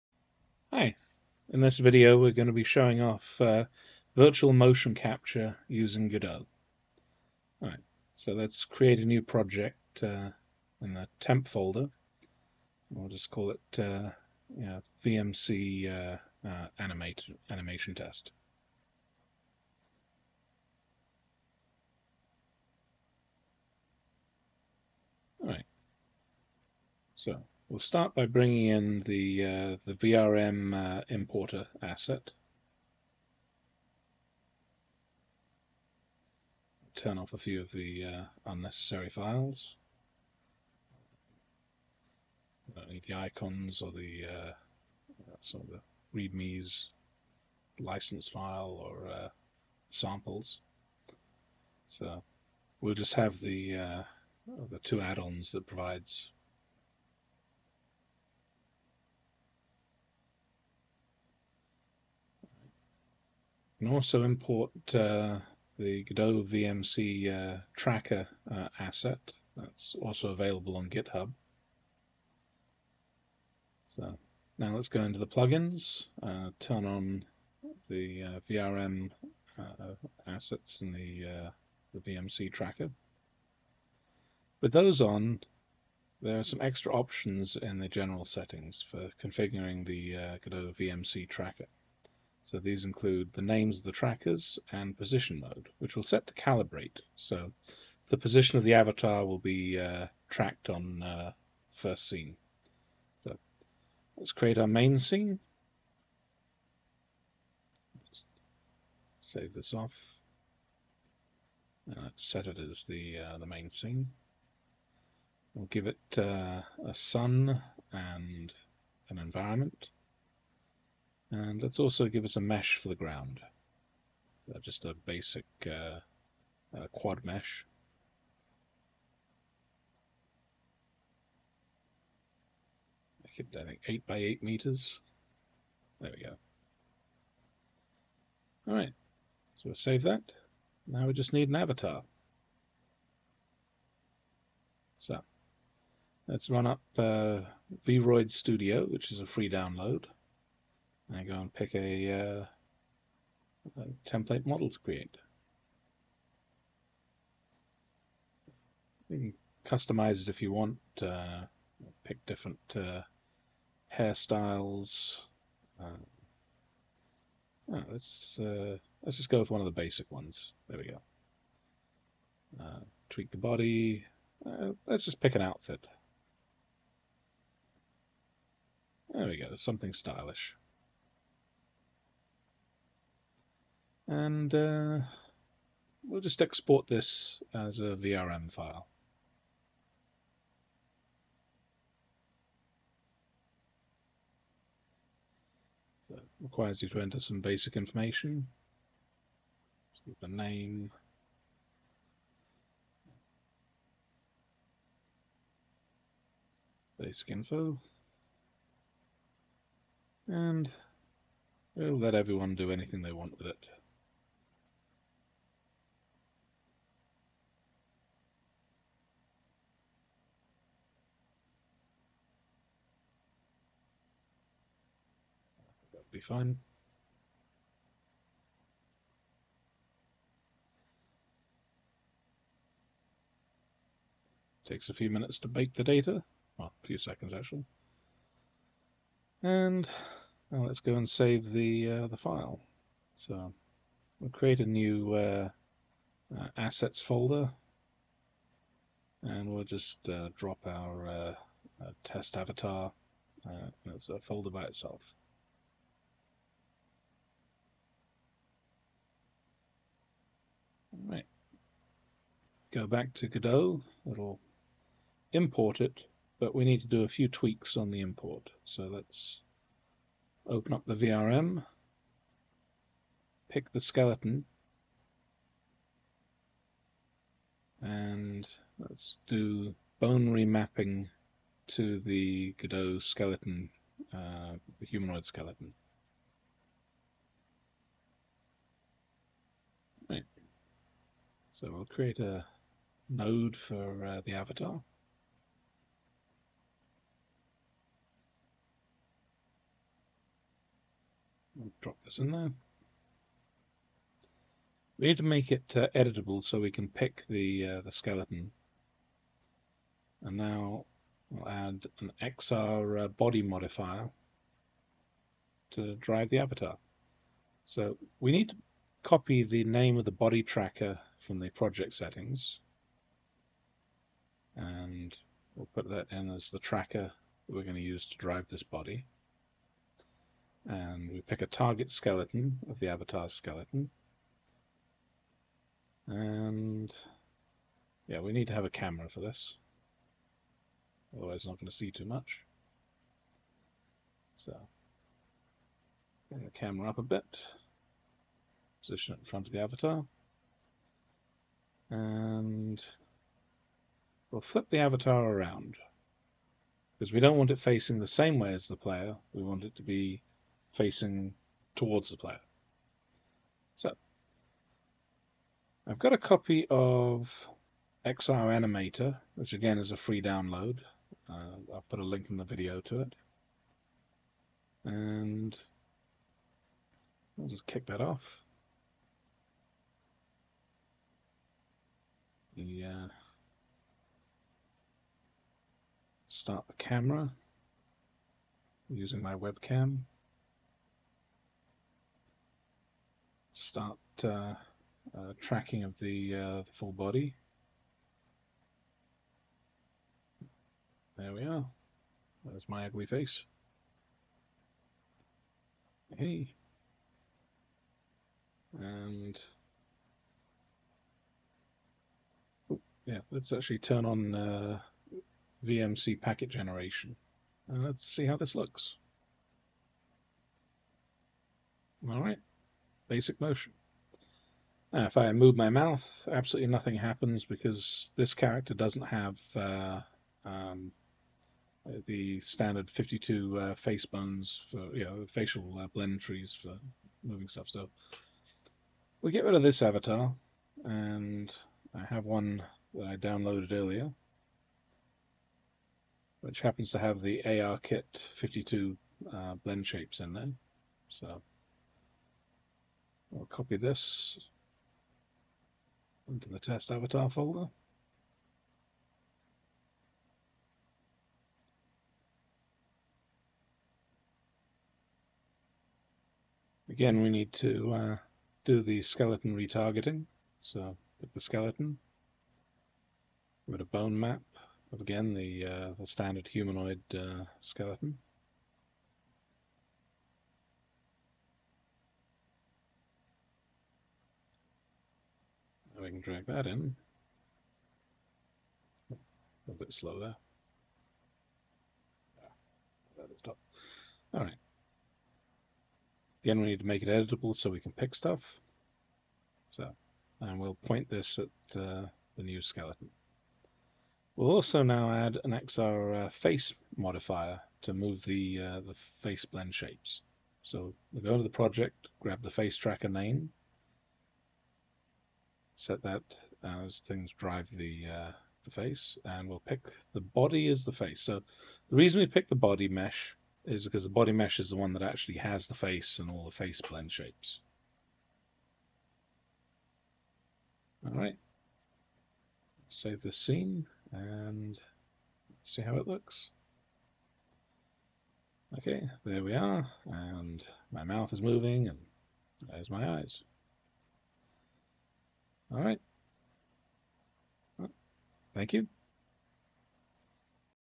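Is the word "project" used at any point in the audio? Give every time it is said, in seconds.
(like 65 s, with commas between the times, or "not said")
9 s, 321 s, 511 s.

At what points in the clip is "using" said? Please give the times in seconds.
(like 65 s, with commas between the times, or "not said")
5 s, 388 s.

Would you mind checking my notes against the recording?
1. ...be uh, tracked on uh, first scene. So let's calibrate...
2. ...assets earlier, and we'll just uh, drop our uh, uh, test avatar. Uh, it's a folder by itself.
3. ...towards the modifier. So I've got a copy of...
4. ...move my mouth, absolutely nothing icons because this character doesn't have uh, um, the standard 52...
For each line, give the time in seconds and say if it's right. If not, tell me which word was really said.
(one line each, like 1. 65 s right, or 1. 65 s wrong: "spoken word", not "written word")
1. 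99 s wrong: "create", not "calibrate"
2. 246 s wrong: "folder", not "earlier"
3. 361 s wrong: "player", not "modifier"
4. 425 s wrong: "happens", not "icons".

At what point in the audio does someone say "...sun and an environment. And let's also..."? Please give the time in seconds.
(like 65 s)
116 s.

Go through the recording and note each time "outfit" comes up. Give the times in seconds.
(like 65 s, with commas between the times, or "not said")
175 s.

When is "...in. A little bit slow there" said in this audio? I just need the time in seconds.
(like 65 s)
486 s.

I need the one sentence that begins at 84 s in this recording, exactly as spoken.
With those on, there are some extra options in the general settings for configuring the Godot VMC tracker.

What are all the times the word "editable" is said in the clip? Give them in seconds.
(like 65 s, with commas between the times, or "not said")
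305 s, 497 s.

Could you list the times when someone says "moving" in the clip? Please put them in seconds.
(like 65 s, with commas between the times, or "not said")
437 s, 541 s.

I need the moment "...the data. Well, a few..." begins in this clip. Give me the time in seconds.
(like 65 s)
235 s.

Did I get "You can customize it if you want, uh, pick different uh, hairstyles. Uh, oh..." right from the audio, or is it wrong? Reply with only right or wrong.
right.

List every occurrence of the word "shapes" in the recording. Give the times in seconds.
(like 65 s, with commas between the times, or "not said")
449 s, 509 s, 527 s.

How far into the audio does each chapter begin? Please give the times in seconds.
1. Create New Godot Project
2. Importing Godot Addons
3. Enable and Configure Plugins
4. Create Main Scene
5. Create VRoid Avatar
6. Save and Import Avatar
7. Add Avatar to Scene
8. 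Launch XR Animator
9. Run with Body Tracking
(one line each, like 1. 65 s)
1. 10 s
2. 26 s
3. 72 s
4. 102 s
5. 142 s
6. 240 s
7. 290 s
8. 365 s
9. 416 s.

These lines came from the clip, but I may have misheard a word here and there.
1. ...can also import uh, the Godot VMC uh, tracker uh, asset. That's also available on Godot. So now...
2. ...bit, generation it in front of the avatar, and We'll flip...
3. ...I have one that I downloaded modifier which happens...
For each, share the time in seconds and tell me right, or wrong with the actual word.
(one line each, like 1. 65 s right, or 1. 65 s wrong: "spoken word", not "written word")
1. 63 s wrong: "GitHub", not "Godot"
2. 347 s wrong: "position", not "generation"
3. 441 s wrong: "earlier", not "modifier".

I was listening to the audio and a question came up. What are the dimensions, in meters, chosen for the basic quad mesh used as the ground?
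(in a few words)
8 by 8.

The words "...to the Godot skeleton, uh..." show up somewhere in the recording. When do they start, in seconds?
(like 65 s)
281 s.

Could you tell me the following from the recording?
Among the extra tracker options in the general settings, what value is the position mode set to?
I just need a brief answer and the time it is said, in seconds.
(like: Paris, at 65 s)
calibrate, at 96 s.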